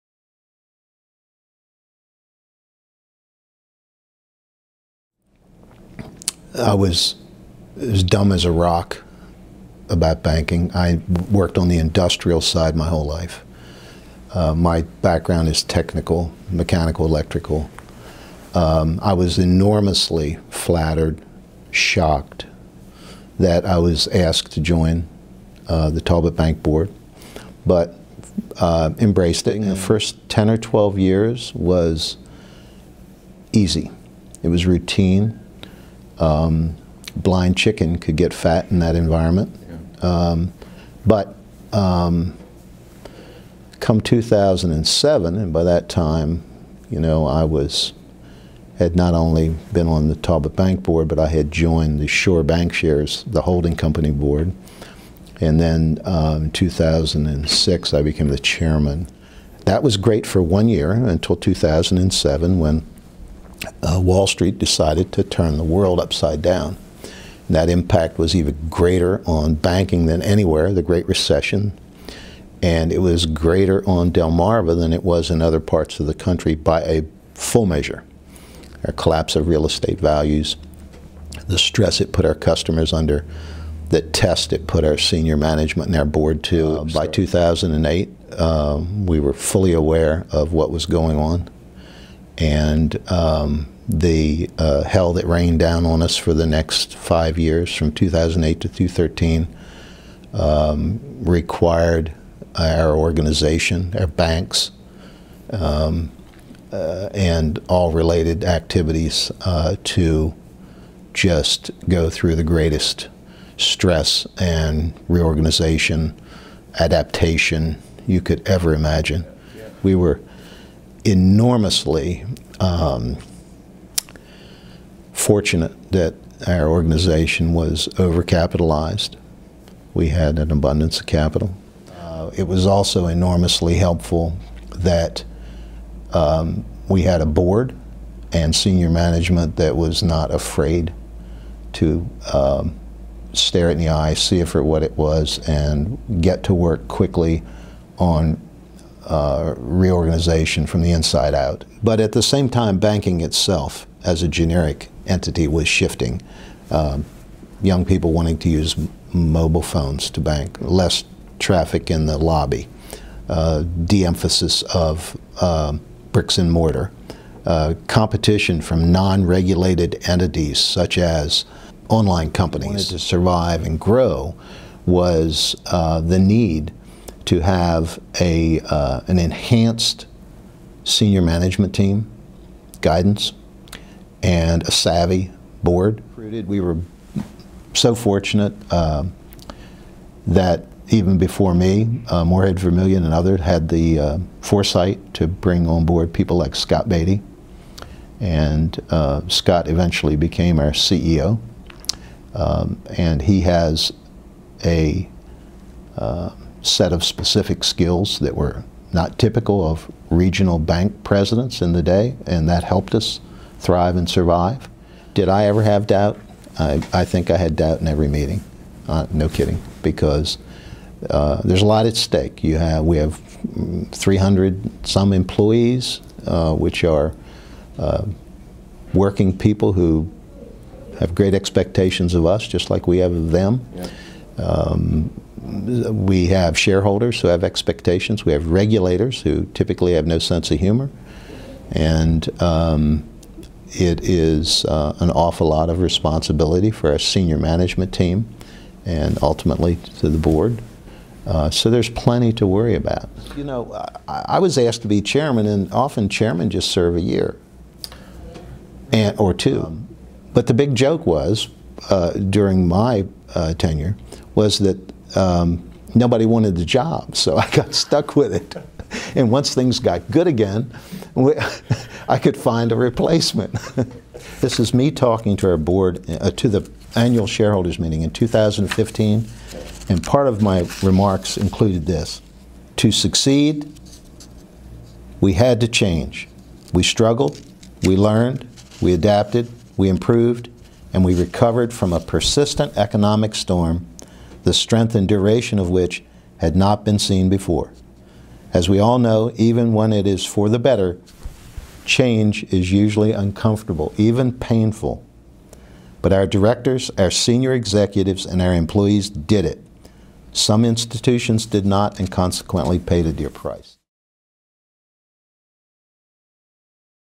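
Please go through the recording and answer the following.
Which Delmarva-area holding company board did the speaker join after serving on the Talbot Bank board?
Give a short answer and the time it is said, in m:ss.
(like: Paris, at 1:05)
Shore Bancshares, at 0:52.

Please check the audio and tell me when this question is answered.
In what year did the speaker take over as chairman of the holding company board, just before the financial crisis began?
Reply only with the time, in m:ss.
0:56.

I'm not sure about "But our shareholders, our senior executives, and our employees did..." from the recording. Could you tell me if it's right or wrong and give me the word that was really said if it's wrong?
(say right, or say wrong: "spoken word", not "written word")
wrong: "directors", not "shareholders".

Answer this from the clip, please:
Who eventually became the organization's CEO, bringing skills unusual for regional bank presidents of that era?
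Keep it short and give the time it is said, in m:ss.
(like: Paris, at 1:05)
Scott Beatty, at 3:16.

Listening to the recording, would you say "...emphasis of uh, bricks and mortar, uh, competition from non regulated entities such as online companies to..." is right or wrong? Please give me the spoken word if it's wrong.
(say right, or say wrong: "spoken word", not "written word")
right.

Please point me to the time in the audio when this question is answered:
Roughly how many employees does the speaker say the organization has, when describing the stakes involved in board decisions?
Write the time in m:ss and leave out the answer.
3:43.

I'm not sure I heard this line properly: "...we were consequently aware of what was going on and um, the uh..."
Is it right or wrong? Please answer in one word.
wrong.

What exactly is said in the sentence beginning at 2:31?
But at the same time, banking itself as a generic entity was shifting.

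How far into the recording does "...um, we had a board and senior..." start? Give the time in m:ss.
2:16.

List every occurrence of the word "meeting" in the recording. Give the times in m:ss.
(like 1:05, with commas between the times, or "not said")
3:38, 4:37.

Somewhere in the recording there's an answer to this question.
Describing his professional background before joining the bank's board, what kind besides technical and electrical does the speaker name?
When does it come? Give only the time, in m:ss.
0:16.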